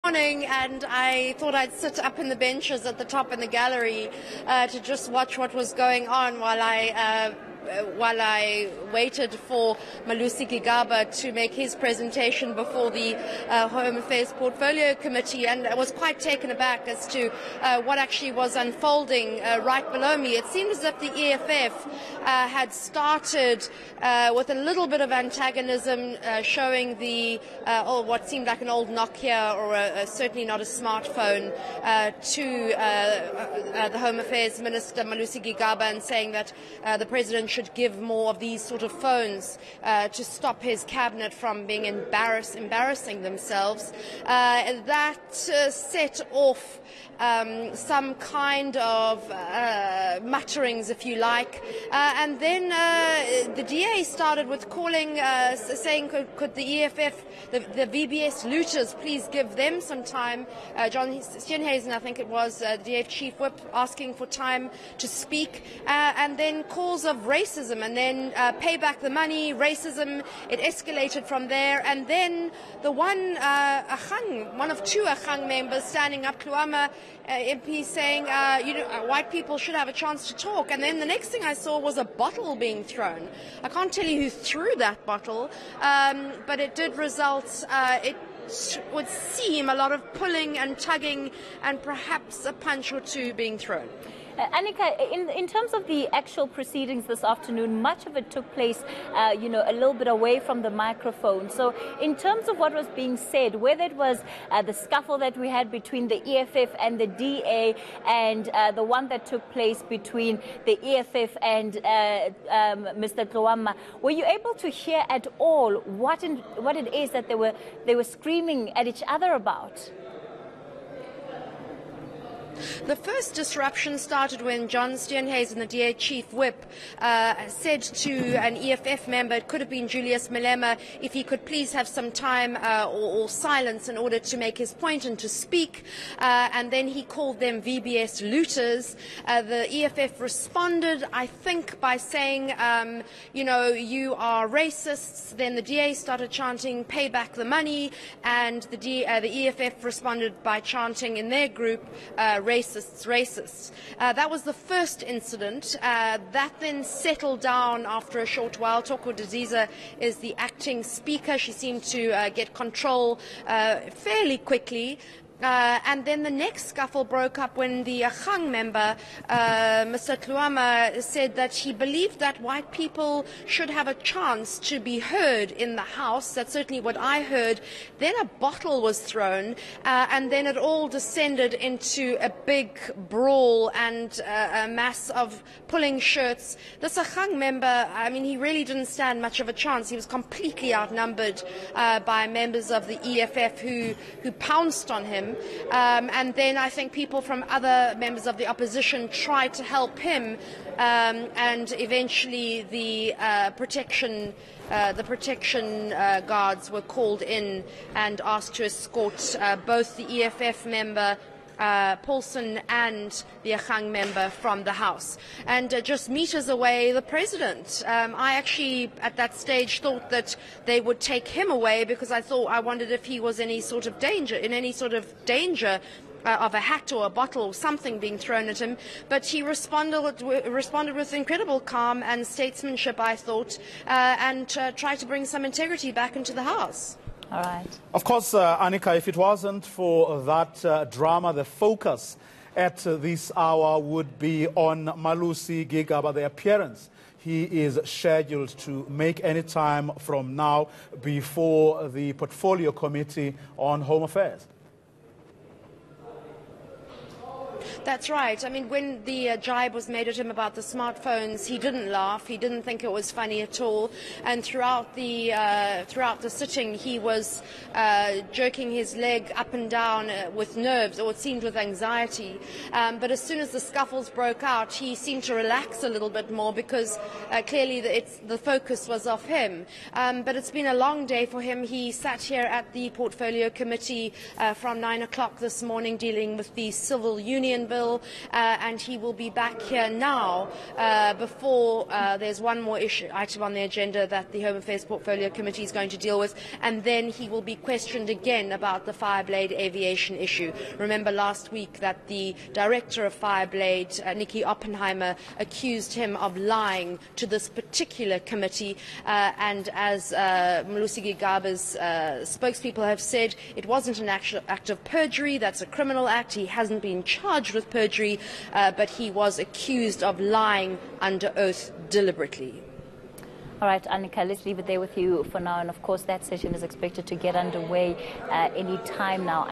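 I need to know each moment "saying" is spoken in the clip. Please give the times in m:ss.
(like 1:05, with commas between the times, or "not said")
0:36, 0:55, 1:17, 2:21.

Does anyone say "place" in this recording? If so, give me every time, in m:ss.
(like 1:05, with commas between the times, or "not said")
1:38, 1:49.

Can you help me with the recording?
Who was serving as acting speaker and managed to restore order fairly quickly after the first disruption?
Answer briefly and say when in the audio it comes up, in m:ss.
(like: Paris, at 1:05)
Thoko Didiza, at 2:38.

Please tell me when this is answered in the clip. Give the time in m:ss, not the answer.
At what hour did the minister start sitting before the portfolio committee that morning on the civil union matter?
4:44.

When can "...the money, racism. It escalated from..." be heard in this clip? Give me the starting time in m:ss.
1:09.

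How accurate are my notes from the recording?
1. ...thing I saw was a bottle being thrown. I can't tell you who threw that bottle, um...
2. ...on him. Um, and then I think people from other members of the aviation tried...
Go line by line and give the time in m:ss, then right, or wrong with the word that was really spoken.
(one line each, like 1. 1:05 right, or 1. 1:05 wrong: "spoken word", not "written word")
1. 1:21 right
2. 3:14 wrong: "opposition", not "aviation".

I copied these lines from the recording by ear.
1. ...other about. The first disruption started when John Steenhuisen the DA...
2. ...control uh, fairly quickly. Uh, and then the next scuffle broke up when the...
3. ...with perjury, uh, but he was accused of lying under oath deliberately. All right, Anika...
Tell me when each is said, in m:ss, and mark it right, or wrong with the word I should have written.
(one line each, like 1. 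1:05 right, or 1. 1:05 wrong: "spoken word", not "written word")
1. 1:59 right
2. 2:42 right
3. 5:17 right.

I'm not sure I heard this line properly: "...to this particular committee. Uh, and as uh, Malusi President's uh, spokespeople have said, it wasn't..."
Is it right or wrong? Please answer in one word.
wrong.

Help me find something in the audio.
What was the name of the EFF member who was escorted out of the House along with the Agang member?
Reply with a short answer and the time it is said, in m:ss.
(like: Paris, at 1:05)
Paulsen, at 3:31.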